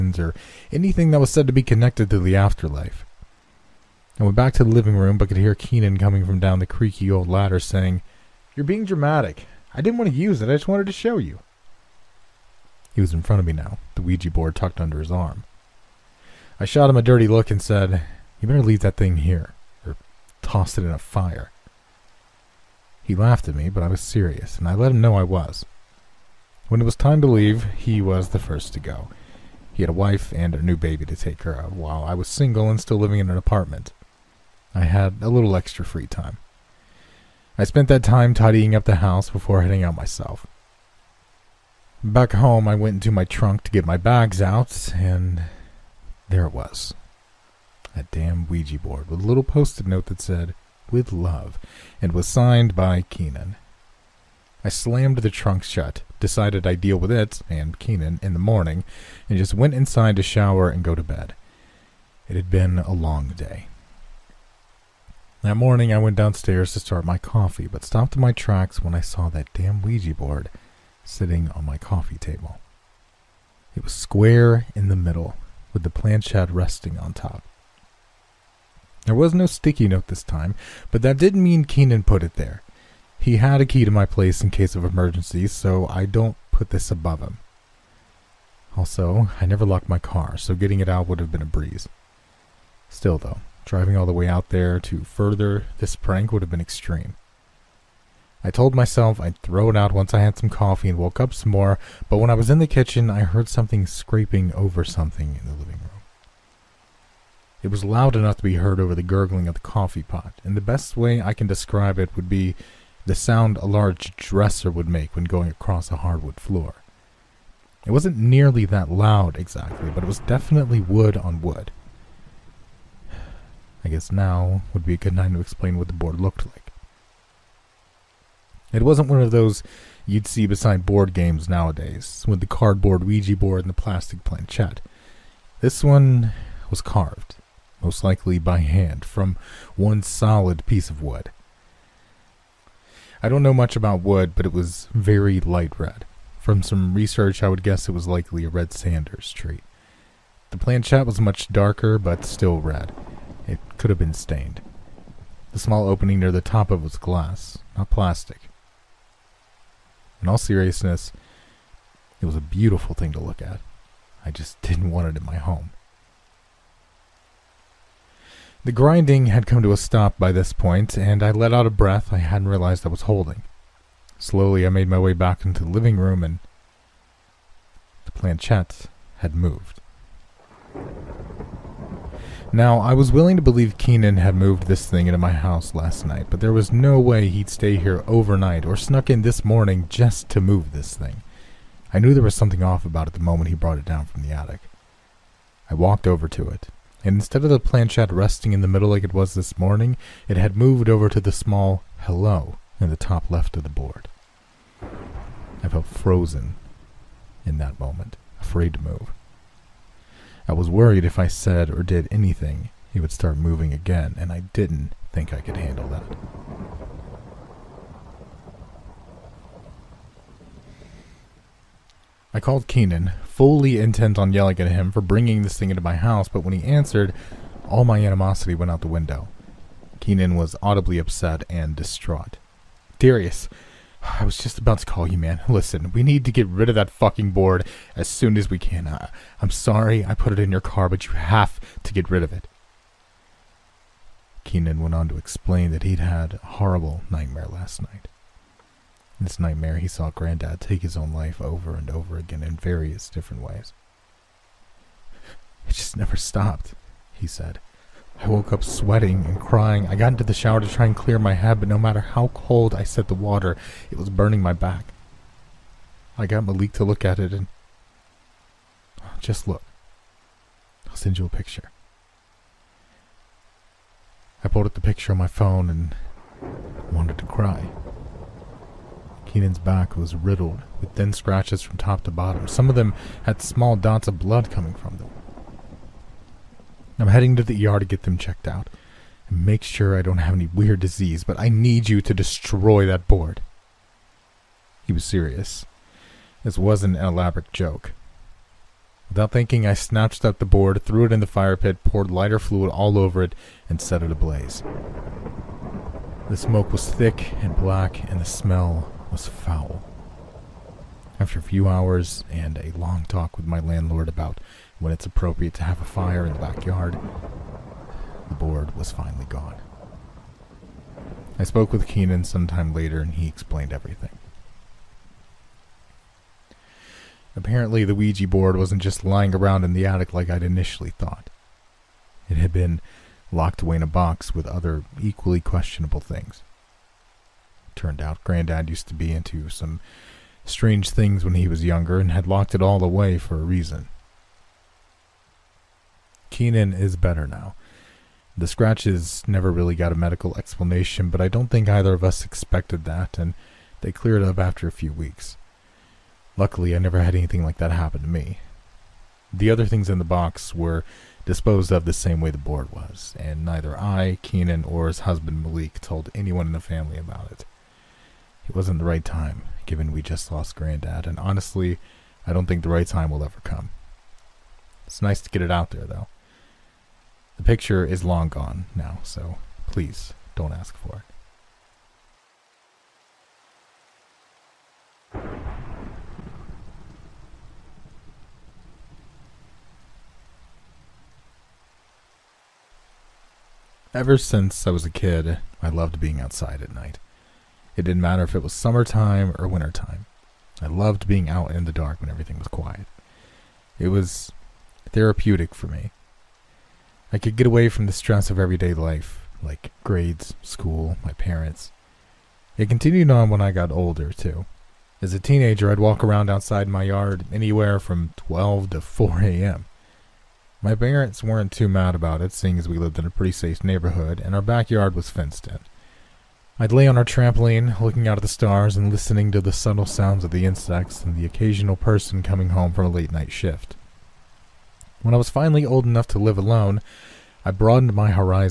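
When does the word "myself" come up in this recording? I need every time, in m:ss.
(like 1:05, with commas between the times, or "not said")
0:39, 1:38.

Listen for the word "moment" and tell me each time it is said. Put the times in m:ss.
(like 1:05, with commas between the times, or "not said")
3:13, 3:27.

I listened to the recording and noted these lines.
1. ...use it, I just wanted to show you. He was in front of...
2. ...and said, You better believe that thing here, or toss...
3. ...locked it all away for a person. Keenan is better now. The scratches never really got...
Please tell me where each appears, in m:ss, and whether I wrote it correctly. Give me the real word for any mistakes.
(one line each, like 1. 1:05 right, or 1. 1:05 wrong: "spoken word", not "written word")
1. 0:10 right
2. 0:17 wrong: "leave", not "believe"
3. 5:42 wrong: "reason", not "person".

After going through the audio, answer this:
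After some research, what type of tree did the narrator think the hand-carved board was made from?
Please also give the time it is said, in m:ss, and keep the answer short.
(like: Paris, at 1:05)
Red Sanders, at 2:28.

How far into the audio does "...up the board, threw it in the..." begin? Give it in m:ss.
5:00.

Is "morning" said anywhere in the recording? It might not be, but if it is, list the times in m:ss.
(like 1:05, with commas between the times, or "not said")
0:58, 1:05, 3:09, 3:19.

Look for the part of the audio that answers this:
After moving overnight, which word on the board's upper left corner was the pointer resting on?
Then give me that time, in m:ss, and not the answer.
3:22.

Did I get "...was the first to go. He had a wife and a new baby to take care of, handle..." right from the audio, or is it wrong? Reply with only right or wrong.
wrong.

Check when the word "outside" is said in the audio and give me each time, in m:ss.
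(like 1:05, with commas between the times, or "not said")
6:36, 6:56.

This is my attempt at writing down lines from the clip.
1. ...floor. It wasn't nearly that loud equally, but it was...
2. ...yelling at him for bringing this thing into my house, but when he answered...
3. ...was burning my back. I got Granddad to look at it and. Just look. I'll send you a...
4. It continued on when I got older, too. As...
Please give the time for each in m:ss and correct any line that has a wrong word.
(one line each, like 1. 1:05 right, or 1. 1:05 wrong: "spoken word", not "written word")
1. 1:56 wrong: "exactly", not "equally"
2. 3:44 right
3. 4:23 wrong: "Malik", not "Granddad"
4. 6:52 right.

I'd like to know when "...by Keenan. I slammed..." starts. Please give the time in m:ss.
0:52.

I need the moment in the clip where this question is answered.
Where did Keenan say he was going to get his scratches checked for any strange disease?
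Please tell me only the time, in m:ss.
4:47.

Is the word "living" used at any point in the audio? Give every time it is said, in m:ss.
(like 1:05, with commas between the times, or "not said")
0:04, 0:32, 1:45, 2:55.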